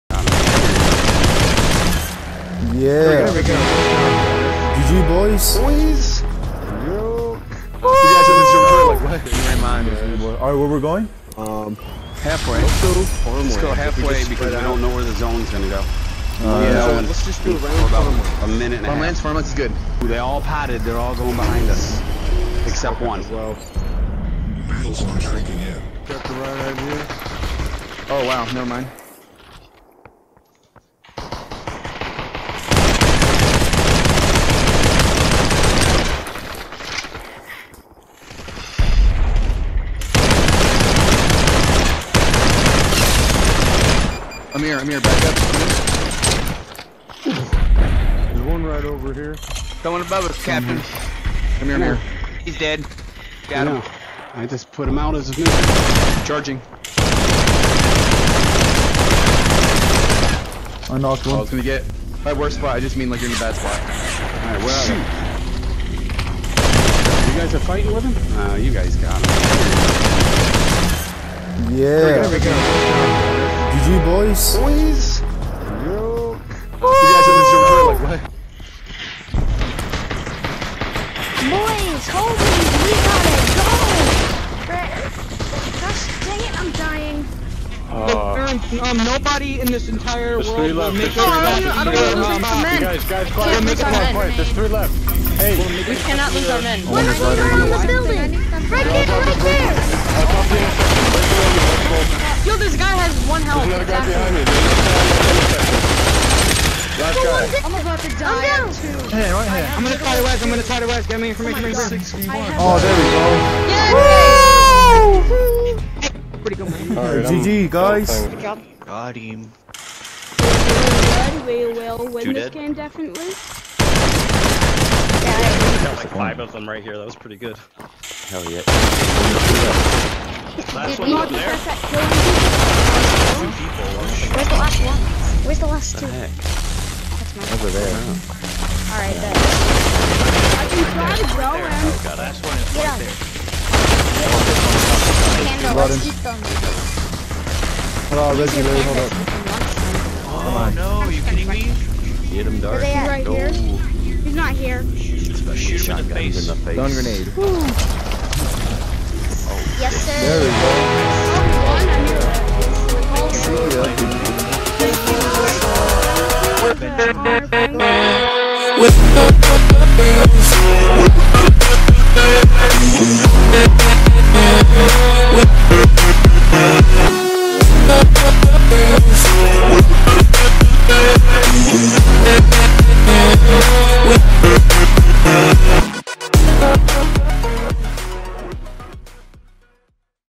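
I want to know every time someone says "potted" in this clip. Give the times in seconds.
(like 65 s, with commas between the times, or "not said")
20 s.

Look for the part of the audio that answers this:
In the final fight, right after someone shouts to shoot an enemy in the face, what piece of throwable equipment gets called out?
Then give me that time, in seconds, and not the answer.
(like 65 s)
156 s.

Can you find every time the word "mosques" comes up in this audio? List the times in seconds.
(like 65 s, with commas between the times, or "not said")
not said.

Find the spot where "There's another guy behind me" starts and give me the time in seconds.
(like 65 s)
103 s.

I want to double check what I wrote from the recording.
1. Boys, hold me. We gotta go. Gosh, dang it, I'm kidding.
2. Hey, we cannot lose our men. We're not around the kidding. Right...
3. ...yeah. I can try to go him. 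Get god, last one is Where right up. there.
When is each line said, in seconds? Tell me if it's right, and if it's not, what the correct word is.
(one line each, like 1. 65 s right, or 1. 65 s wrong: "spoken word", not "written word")
1. 81 s wrong: "dying", not "kidding"
2. 95 s wrong: "building", not "kidding"
3. 139 s wrong: "Get", not "Where".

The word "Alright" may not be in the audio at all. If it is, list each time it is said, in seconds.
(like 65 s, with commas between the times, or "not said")
10 s, 64 s, 138 s.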